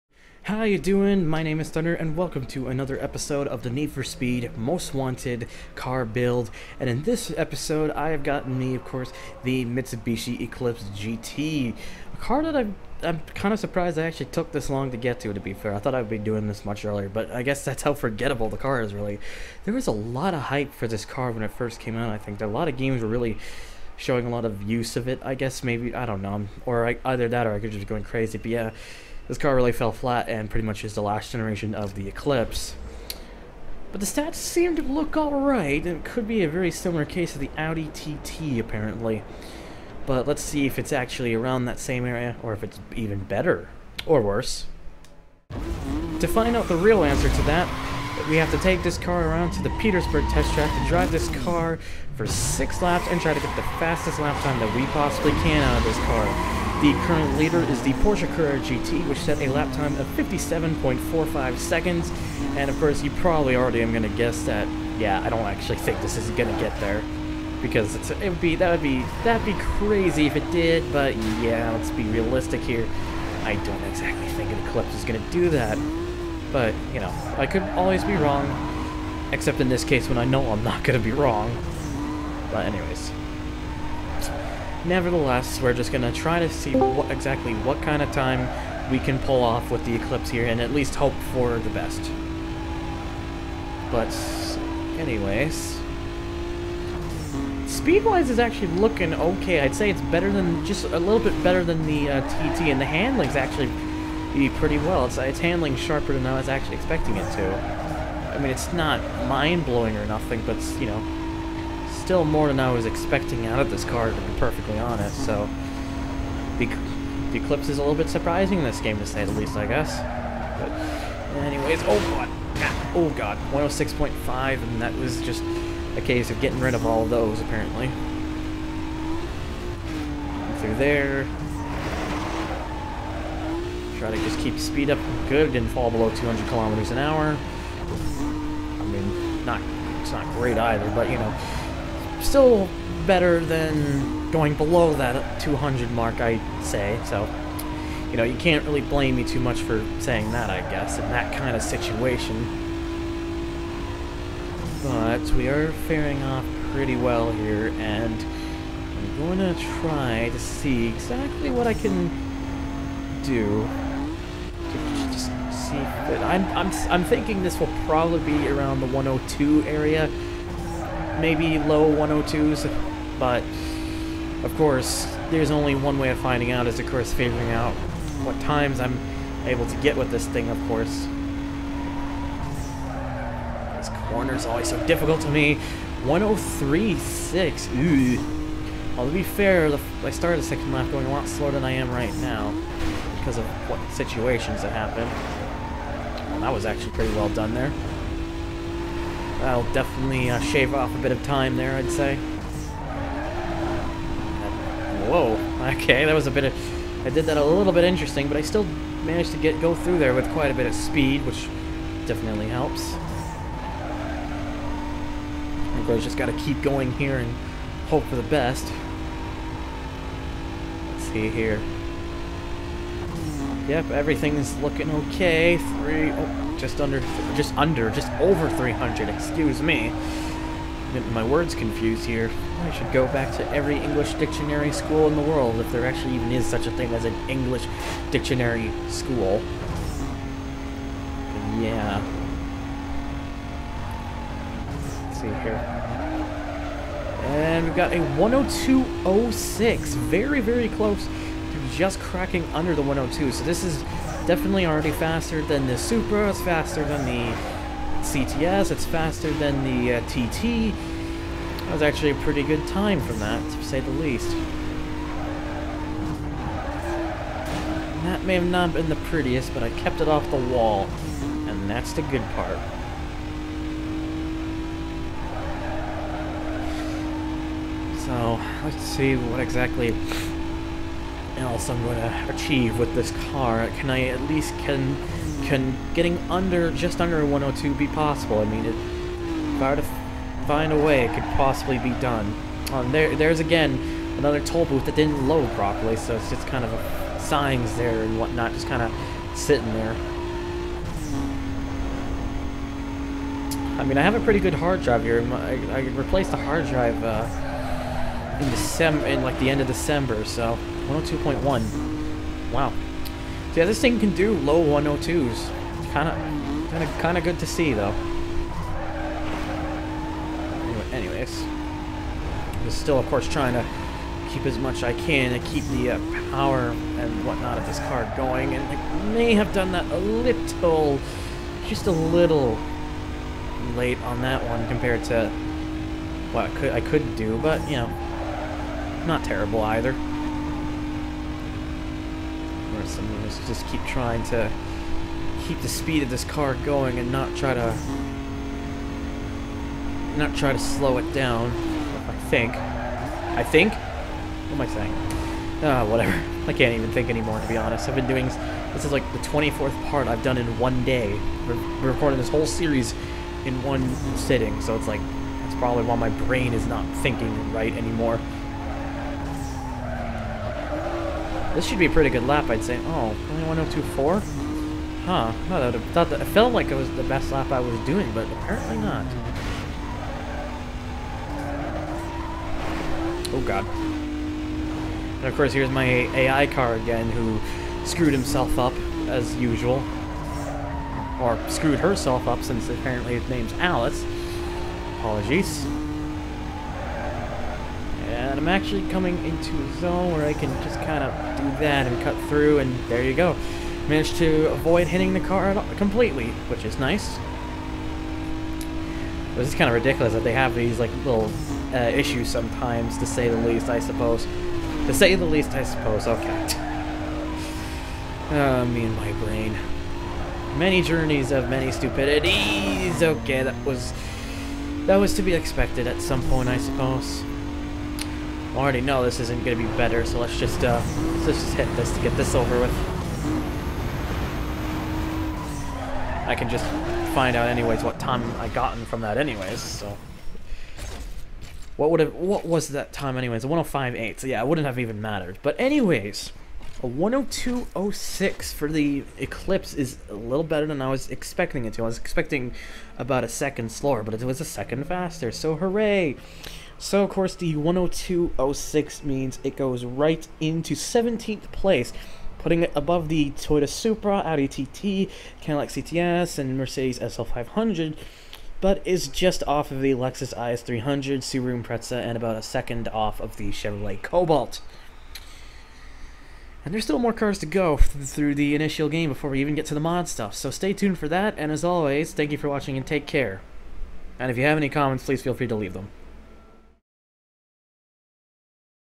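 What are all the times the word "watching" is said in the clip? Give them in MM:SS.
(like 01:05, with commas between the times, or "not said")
08:02.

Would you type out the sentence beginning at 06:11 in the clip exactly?
This should be a pretty good lap, I'd say.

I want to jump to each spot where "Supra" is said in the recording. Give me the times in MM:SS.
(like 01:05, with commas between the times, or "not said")
04:15, 07:43.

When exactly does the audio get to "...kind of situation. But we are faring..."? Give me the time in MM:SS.
02:31.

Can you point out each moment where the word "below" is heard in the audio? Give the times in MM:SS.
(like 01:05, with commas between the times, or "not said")
02:15, 02:24.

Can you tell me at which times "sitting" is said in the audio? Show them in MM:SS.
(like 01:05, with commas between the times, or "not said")
04:59, 06:04.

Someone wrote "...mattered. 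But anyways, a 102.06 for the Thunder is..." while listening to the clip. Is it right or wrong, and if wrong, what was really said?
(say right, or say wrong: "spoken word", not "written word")
wrong: "Eclipse", not "Thunder".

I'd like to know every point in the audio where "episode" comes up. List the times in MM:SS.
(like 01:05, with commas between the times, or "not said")
00:03, 00:07.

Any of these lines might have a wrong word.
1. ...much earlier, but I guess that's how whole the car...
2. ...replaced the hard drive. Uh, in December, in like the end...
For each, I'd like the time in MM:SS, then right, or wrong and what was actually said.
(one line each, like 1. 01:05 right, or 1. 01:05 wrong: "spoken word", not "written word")
1. 00:16 wrong: "forgettable", not "whole"
2. 05:05 right.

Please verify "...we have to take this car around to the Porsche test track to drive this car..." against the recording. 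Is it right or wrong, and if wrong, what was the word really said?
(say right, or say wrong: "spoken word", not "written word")
wrong: "Petersburg", not "Porsche".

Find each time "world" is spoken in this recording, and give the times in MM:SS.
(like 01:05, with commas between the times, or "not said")
03:55.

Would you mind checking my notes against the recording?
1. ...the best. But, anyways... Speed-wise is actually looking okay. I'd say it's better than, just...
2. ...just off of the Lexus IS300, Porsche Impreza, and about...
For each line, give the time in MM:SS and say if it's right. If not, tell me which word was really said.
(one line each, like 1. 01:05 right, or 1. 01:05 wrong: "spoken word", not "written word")
1. 01:31 right
2. 07:49 wrong: "Subaru", not "Porsche".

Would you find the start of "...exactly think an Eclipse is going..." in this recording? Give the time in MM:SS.
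01:13.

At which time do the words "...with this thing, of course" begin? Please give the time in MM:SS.
02:59.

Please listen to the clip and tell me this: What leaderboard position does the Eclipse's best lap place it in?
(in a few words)
17th place.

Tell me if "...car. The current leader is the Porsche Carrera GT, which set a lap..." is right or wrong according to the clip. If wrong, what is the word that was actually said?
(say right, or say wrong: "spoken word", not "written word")
right.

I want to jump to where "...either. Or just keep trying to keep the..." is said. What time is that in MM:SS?
05:39.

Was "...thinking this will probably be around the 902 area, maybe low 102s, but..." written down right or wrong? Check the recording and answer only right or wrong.
wrong.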